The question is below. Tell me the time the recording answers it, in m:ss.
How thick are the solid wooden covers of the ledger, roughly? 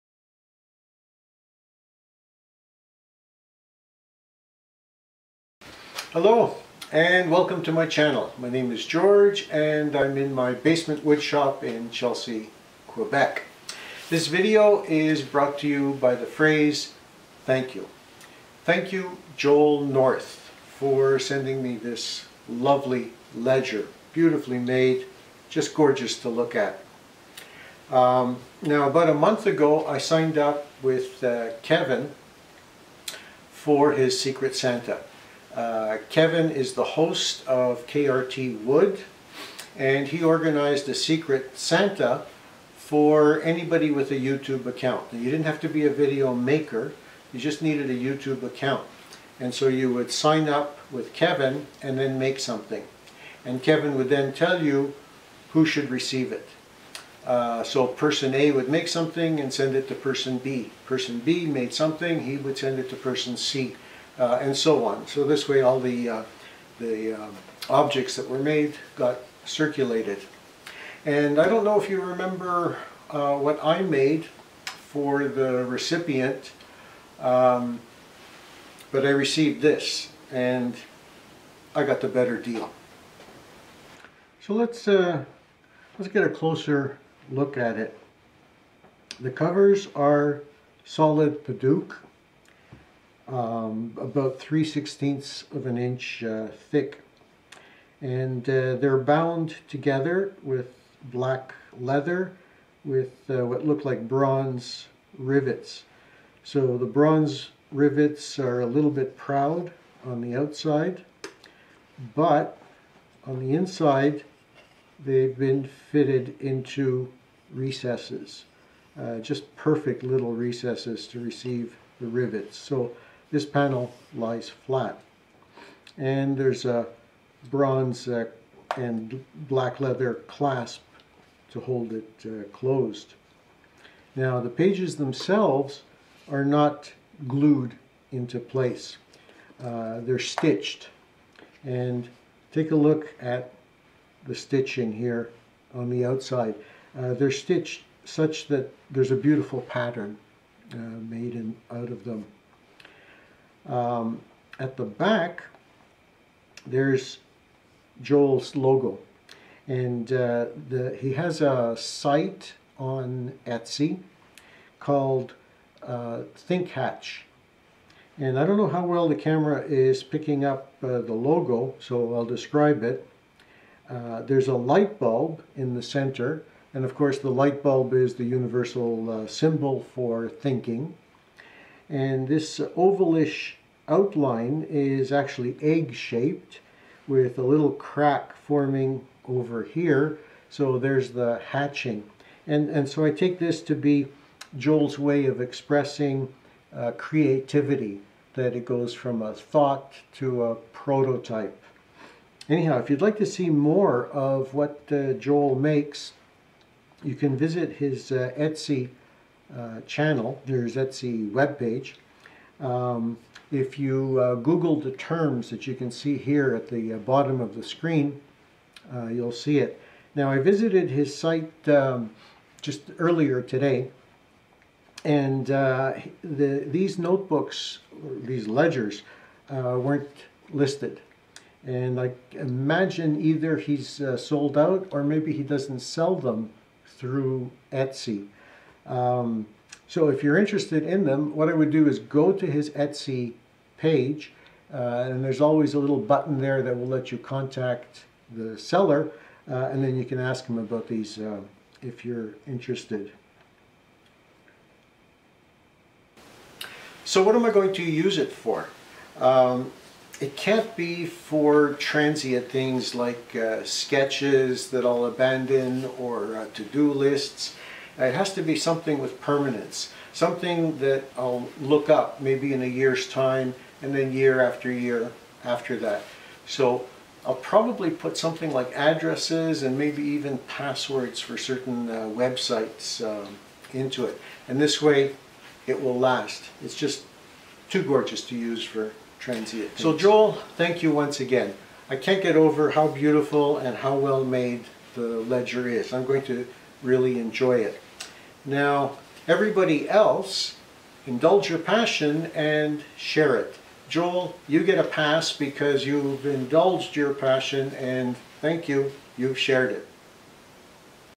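1:34.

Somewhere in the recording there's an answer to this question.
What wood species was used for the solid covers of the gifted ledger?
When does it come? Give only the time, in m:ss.
1:31.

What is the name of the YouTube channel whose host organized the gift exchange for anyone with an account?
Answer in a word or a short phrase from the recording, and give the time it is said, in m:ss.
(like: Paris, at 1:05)
KRT Wood, at 0:37.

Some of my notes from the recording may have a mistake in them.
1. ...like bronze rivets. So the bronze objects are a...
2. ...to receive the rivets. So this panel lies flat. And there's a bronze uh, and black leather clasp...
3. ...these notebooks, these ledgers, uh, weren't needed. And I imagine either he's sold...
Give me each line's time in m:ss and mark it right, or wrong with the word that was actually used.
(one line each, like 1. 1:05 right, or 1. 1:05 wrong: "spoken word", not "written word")
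1. 1:43 wrong: "rivets", not "objects"
2. 2:01 right
3. 3:46 wrong: "listed", not "needed".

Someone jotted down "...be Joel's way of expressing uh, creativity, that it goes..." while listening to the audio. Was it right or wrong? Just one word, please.
right.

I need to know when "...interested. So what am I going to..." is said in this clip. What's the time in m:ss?
4:12.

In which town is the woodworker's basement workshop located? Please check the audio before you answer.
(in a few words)
Chelsea, Quebec.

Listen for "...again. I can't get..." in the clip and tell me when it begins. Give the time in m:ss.
4:51.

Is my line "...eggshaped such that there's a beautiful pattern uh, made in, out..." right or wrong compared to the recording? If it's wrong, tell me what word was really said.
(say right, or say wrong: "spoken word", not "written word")
wrong: "stitched", not "eggshaped".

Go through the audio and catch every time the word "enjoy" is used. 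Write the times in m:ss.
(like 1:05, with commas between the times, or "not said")
4:57.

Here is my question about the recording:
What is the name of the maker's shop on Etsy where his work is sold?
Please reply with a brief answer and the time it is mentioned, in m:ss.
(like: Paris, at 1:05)
Thinkhatch, at 2:46.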